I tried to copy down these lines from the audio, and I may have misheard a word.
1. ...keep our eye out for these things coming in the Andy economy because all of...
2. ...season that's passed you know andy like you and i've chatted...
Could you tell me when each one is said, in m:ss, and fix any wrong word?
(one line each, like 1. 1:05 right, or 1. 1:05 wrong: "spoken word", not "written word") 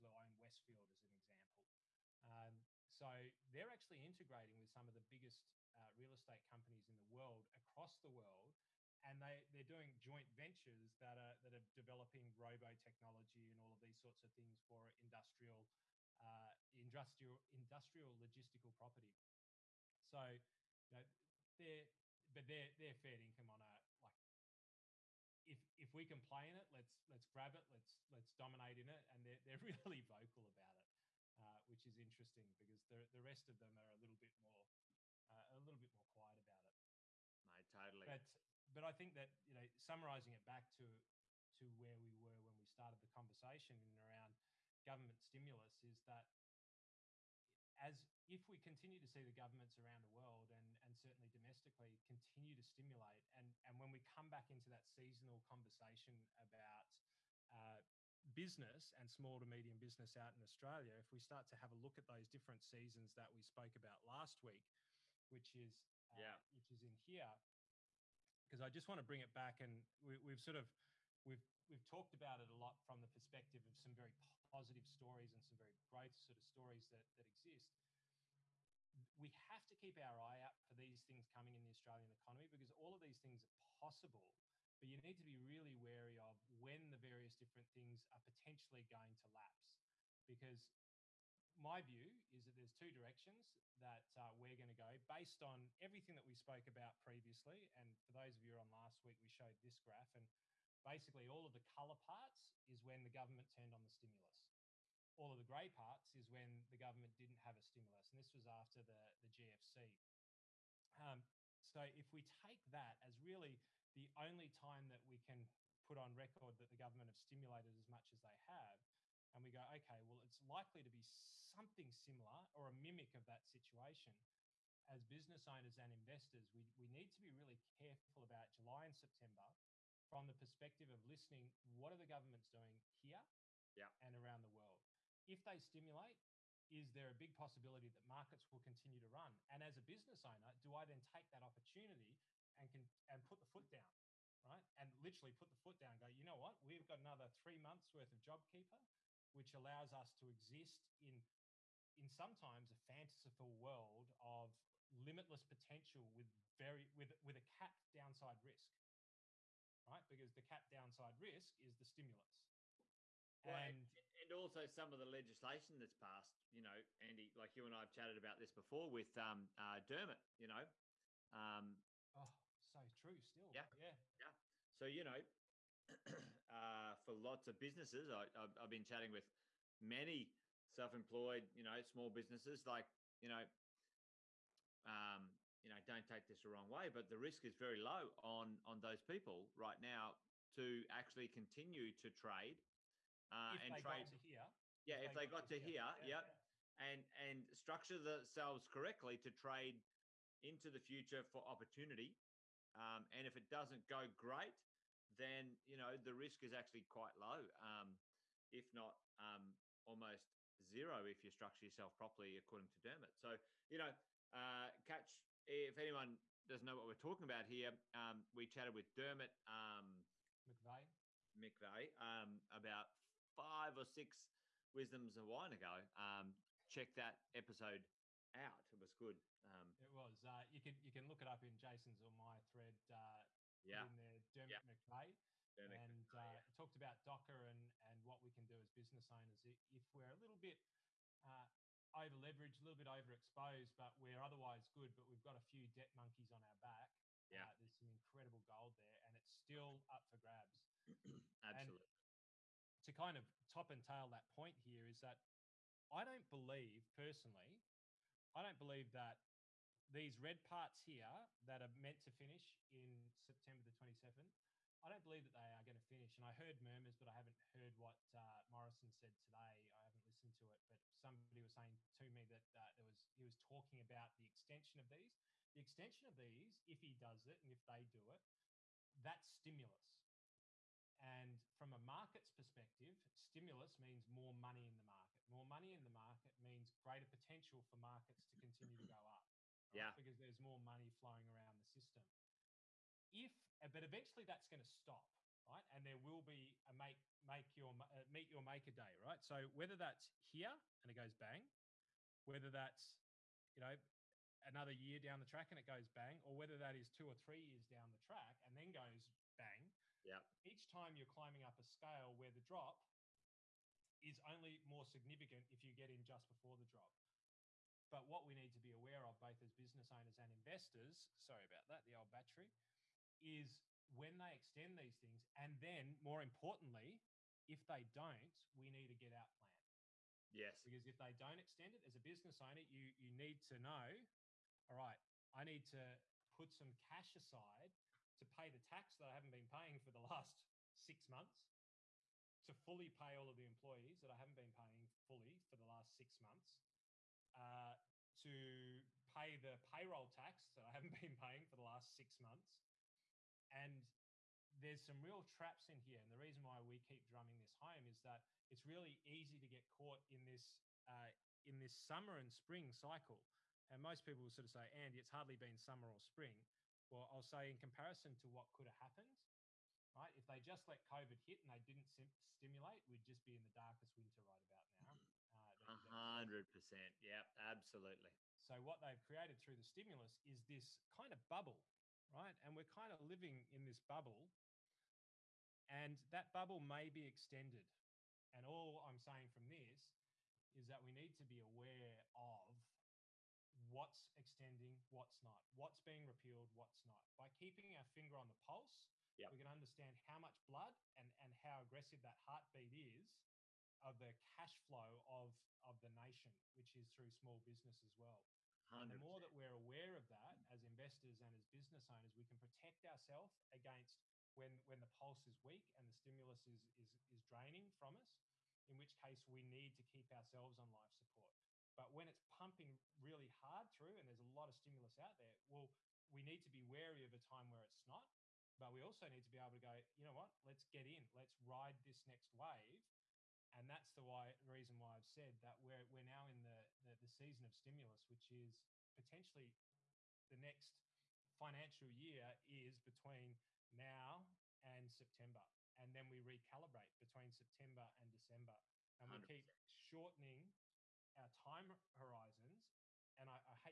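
1. 1:19 wrong: "Australian", not "Andy"
2. 2:45 wrong: "legislation", not "season".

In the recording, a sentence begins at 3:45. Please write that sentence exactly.
Um, check that episode out; it was good.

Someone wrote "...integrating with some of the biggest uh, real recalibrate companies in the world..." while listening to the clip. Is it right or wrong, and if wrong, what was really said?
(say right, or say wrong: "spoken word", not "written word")
wrong: "estate", not "recalibrate".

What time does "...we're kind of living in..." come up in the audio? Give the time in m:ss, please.
6:22.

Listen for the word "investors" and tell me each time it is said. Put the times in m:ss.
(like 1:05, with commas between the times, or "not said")
2:05, 5:20, 6:50.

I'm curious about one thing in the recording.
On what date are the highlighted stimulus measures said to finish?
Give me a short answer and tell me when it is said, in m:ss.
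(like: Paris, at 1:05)
September 27, at 4:23.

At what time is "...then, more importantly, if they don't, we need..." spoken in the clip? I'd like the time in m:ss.
5:25.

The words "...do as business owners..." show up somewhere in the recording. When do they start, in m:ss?
3:58.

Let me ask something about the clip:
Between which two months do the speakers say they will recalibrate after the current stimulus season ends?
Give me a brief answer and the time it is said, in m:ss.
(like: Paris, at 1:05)
September and December, at 7:27.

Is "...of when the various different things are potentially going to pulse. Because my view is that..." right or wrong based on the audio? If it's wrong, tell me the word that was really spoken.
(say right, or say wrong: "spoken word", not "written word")
wrong: "lapse", not "pulse".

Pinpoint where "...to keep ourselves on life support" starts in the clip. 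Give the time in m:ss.
6:59.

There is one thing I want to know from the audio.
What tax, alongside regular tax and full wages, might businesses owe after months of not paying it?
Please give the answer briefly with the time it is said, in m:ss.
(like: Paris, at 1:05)
Payroll tax, at 5:49.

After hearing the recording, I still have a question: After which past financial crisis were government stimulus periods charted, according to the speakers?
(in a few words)
GFC.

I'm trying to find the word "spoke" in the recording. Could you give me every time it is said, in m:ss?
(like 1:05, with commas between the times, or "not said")
1:03, 1:36.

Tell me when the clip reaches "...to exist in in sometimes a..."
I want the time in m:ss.
2:30.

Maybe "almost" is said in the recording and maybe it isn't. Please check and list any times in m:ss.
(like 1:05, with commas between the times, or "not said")
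3:29.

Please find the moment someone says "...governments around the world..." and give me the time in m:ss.
0:49.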